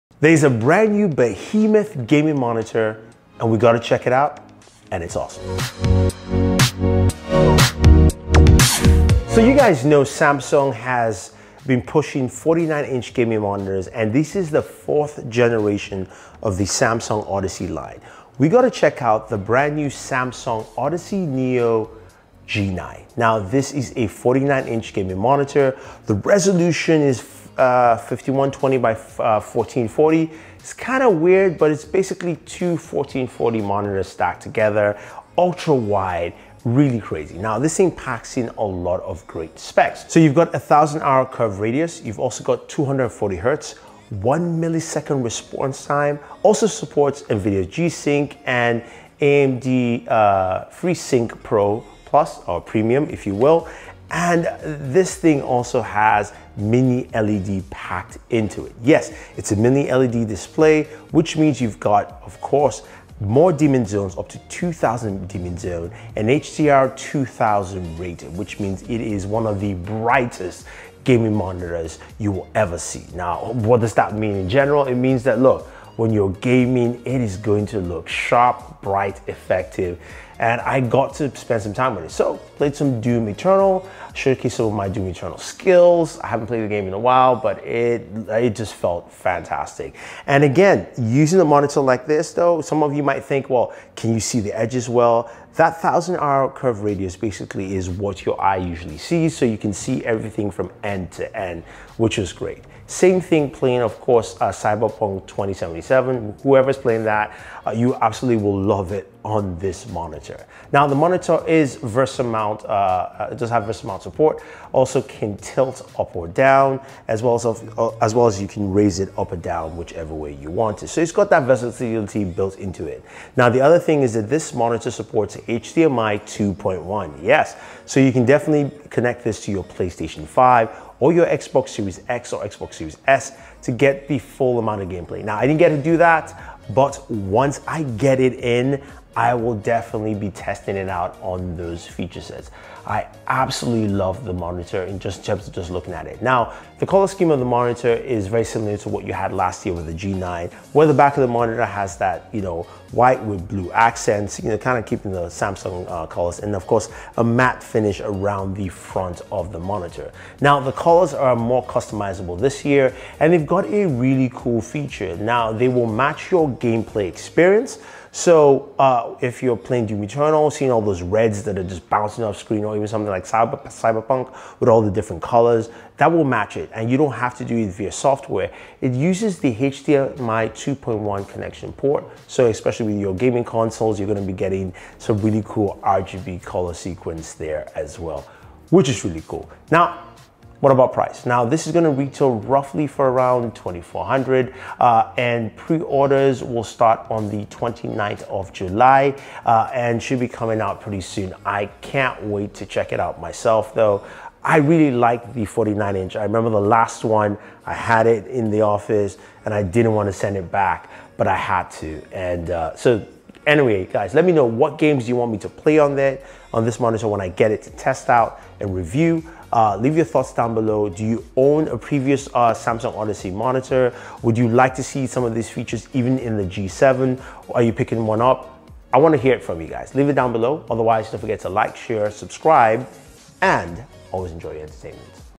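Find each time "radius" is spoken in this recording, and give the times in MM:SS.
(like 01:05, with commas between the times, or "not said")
00:41, 01:36.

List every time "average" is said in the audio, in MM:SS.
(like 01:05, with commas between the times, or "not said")
not said.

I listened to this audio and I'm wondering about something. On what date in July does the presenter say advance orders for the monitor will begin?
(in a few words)
29th of July.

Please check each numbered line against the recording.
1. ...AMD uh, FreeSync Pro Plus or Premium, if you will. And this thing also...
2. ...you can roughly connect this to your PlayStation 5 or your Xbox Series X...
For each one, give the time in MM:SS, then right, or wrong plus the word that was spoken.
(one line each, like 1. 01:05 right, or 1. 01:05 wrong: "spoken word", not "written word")
1. 00:49 right
2. 02:07 wrong: "definitely", not "roughly".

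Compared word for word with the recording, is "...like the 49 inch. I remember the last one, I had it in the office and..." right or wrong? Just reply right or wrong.
right.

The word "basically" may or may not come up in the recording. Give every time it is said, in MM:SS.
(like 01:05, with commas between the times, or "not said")
00:31, 01:37.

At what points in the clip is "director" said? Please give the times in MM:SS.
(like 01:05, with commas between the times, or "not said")
not said.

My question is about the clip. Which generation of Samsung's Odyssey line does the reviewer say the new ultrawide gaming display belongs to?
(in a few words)
fourth.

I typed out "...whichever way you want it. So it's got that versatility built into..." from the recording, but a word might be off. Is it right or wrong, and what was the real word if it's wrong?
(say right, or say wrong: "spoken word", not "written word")
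right.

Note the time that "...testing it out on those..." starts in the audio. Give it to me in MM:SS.
02:20.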